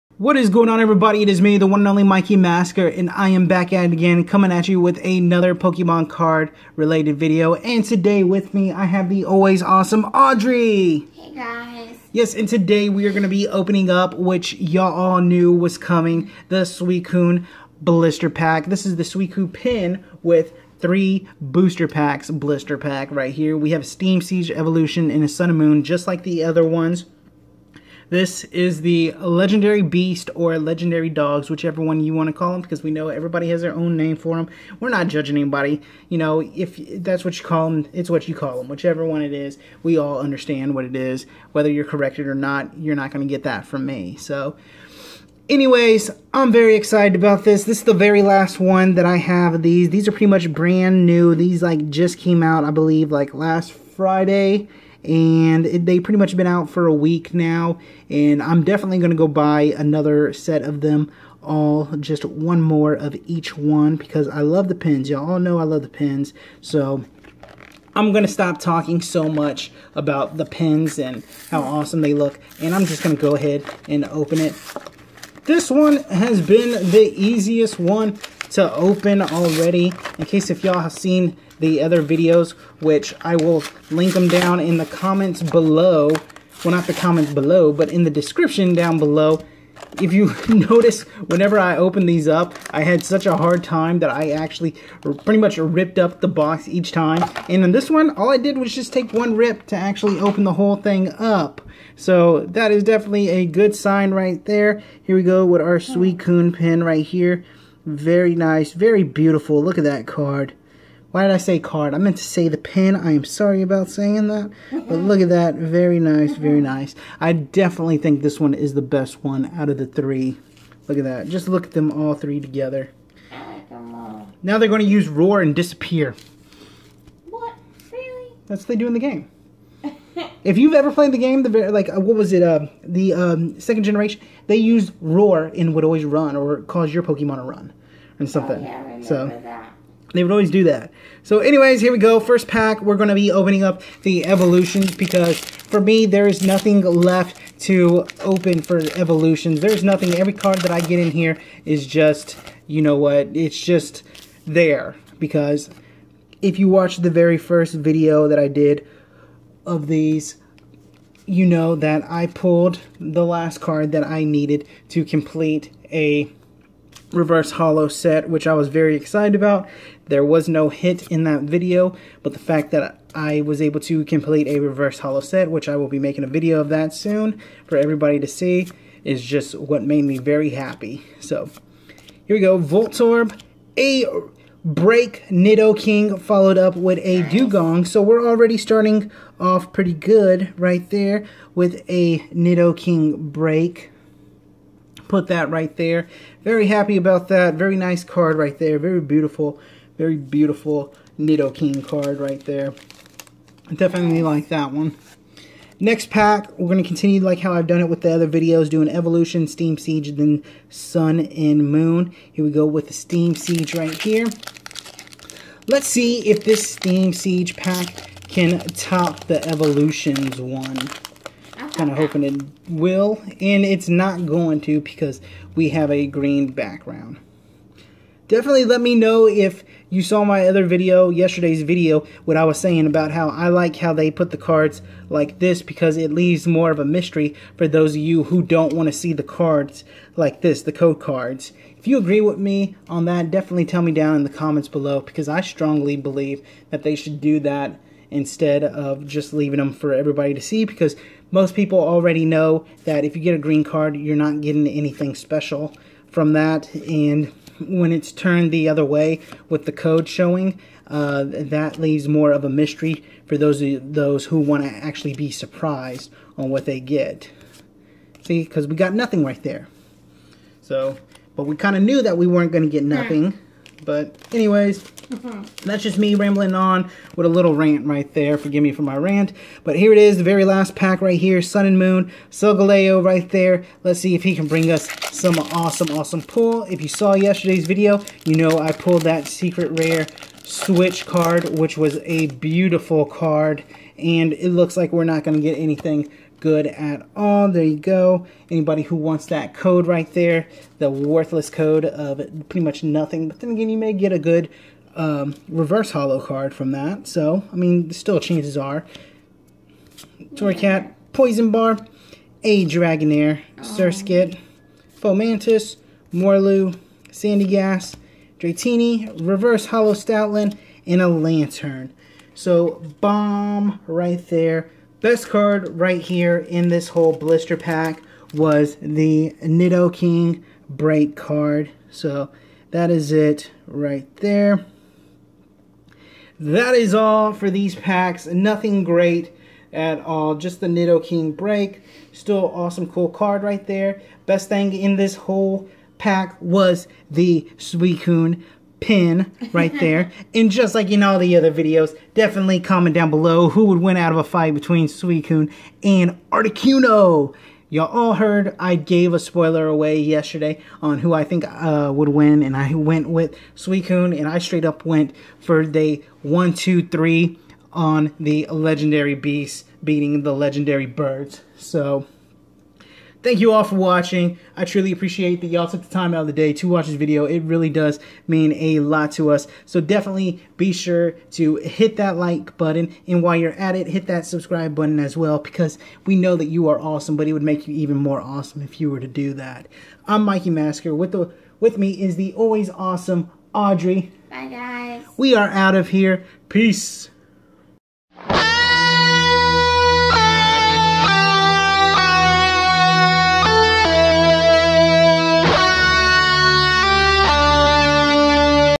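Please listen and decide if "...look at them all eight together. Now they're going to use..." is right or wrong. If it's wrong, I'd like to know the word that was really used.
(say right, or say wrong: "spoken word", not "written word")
wrong: "three", not "eight".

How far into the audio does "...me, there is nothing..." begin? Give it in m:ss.
2:25.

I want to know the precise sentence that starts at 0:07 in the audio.
And today with me, I have the always awesome Audrey!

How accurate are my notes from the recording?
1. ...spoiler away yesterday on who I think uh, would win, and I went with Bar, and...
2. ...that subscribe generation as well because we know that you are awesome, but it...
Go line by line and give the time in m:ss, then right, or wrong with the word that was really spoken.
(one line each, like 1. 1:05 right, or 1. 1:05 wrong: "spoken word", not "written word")
1. 5:59 wrong: "Suicune", not "Bar"
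2. 6:24 wrong: "button", not "generation".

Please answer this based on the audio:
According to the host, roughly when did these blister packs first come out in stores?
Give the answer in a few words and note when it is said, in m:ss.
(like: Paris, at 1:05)
last Friday, at 0:53.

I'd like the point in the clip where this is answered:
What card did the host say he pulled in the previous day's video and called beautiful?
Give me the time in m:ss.
4:49.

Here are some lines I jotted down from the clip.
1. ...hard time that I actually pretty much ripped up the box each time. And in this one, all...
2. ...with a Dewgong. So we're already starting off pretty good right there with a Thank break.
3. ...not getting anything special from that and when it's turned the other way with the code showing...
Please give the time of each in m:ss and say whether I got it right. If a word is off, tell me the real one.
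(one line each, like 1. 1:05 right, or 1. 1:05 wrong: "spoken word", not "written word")
1. 1:33 right
2. 3:06 wrong: "Nidoking", not "Thank"
3. 4:14 right.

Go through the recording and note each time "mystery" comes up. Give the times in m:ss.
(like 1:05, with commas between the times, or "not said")
3:56, 4:22.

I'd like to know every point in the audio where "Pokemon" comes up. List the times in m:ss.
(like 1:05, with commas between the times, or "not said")
0:05, 2:17.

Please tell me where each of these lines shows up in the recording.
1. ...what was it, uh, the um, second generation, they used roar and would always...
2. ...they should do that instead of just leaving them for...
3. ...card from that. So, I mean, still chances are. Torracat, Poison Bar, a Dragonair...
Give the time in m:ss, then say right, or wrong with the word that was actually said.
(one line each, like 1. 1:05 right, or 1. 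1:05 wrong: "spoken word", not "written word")
1. 2:11 right
2. 4:06 right
3. 5:06 right.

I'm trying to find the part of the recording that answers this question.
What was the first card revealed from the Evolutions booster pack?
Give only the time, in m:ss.
3:02.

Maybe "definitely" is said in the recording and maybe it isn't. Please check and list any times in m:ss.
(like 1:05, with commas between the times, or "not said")
0:58, 1:42, 1:57, 3:23, 3:48, 4:03, 5:52, 6:19.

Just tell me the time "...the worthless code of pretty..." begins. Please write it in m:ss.
5:00.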